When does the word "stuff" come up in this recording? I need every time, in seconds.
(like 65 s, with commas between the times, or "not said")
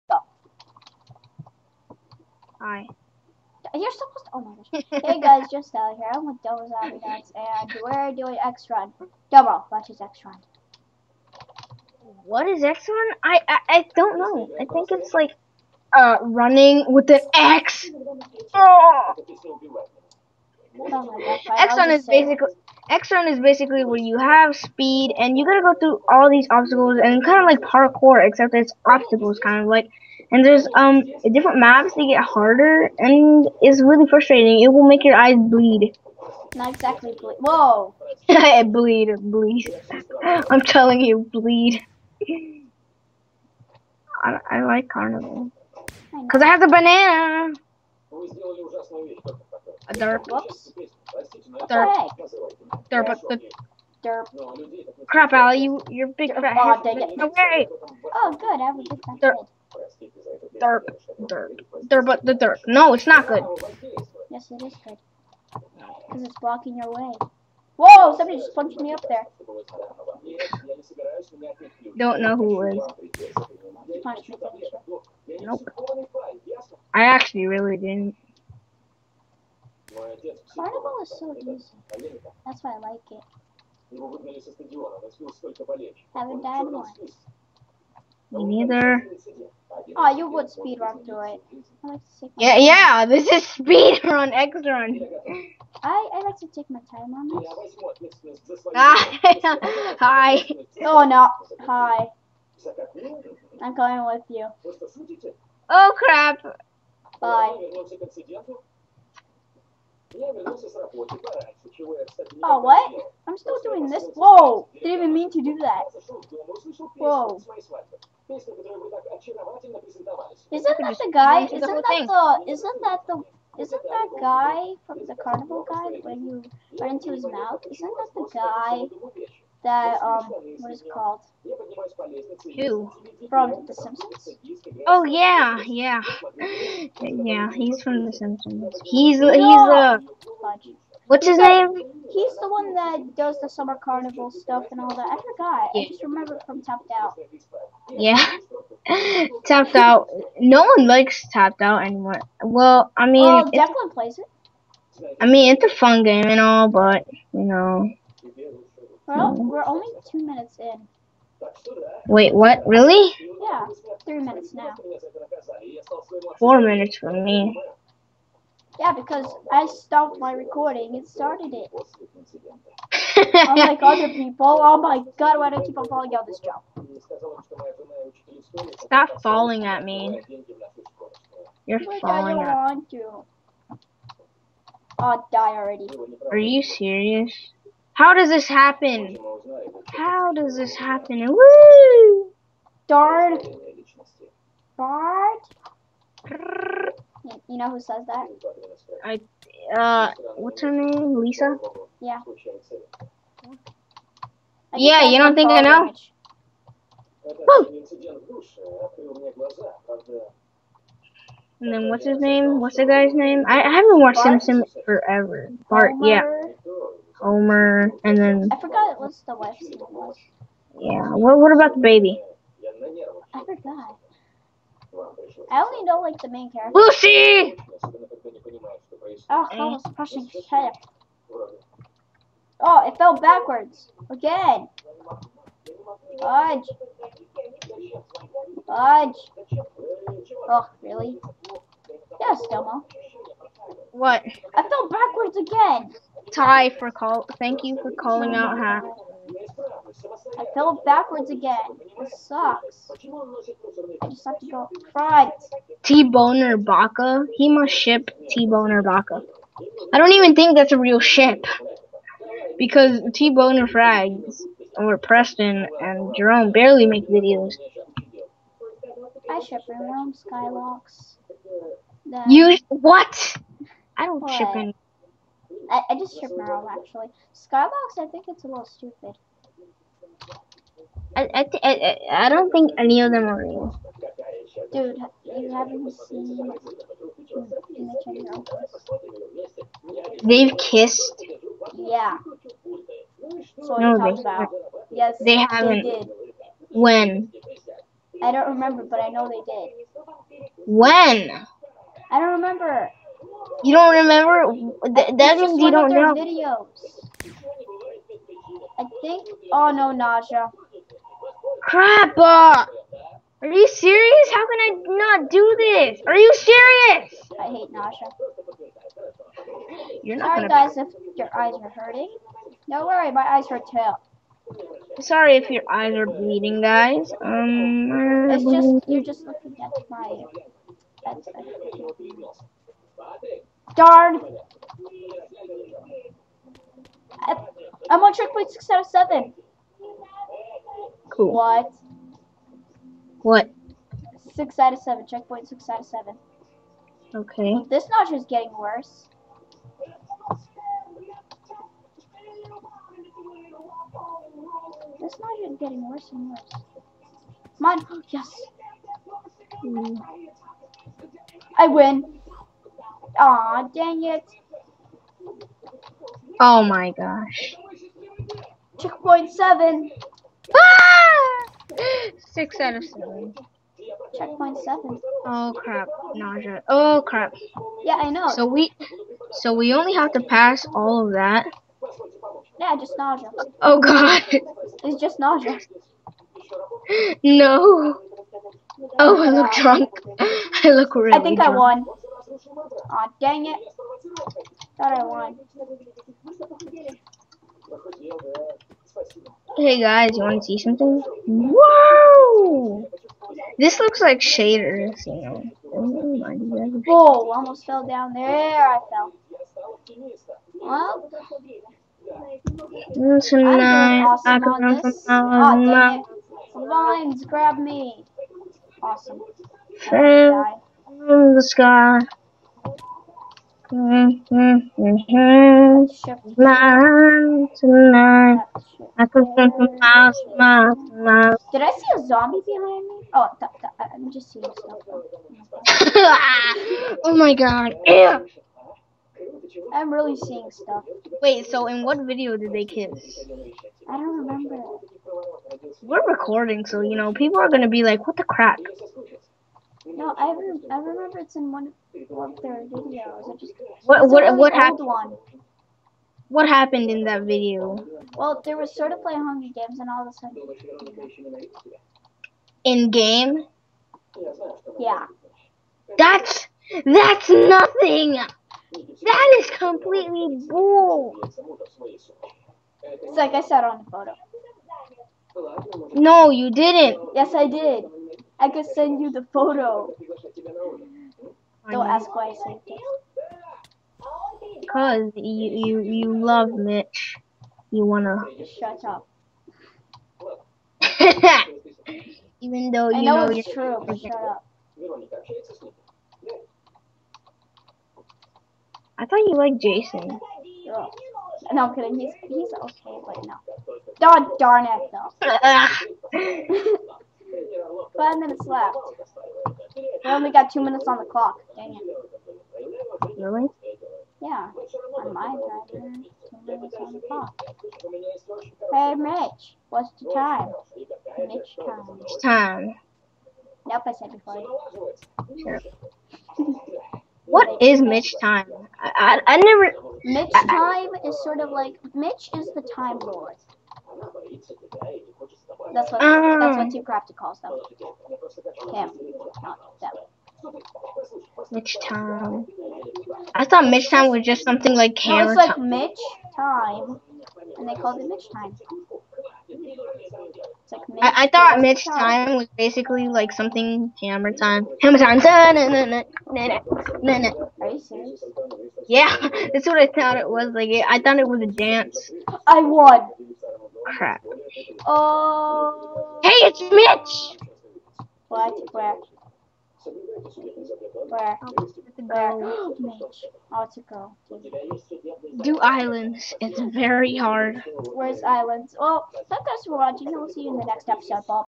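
144 s, 434 s, 440 s.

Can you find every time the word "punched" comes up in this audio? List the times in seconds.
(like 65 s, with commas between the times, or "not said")
68 s.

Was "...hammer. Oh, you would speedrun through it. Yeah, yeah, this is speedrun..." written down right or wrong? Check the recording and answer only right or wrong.
wrong.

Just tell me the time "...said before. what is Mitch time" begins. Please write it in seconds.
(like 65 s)
523 s.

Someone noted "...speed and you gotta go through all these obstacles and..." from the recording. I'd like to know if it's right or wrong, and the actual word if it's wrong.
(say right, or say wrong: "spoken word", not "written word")
right.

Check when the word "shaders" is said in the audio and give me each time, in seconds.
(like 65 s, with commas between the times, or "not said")
404 s.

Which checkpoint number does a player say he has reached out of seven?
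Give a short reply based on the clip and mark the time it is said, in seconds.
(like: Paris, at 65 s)
6, at 337 s.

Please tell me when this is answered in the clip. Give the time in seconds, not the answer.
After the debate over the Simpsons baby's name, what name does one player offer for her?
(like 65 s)
226 s.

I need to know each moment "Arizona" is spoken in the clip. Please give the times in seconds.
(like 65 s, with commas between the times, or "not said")
not said.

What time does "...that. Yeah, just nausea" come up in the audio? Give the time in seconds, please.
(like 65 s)
381 s.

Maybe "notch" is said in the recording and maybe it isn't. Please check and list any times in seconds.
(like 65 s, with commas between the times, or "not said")
347 s, 355 s.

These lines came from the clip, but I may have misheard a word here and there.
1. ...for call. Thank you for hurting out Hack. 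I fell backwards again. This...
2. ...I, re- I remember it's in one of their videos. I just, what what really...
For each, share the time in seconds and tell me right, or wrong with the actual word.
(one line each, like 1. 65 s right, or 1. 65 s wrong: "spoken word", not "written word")
1. 246 s wrong: "calling", not "hurting"
2. 450 s right.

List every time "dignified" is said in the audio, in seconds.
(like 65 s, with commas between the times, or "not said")
not said.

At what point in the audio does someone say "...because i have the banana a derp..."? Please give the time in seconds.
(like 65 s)
46 s.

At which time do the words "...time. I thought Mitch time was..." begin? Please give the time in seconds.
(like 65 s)
541 s.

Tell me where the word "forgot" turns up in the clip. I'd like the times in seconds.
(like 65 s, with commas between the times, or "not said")
145 s, 218 s, 223 s.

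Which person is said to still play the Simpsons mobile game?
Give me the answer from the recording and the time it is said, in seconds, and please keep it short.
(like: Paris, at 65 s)
Declan, at 153 s.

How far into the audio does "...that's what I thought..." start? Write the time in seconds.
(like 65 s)
559 s.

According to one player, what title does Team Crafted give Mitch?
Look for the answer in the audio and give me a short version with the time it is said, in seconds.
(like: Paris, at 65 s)
time lord, at 531 s.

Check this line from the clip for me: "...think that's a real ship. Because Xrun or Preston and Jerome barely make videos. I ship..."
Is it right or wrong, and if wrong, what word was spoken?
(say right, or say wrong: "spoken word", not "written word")
wrong: "TBNRfrags", not "Xrun".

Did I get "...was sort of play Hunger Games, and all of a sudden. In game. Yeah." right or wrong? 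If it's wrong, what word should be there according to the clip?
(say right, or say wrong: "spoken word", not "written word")
right.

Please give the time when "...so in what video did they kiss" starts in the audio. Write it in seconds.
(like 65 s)
441 s.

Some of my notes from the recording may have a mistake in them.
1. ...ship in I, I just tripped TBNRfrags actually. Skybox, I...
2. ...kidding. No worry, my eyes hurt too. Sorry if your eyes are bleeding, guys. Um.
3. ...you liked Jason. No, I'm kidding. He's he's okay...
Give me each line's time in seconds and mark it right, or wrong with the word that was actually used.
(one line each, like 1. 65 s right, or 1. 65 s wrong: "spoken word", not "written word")
1. 274 s wrong: "Merle", not "TBNRfrags"
2. 321 s wrong: "hurting", not "kidding"
3. 499 s right.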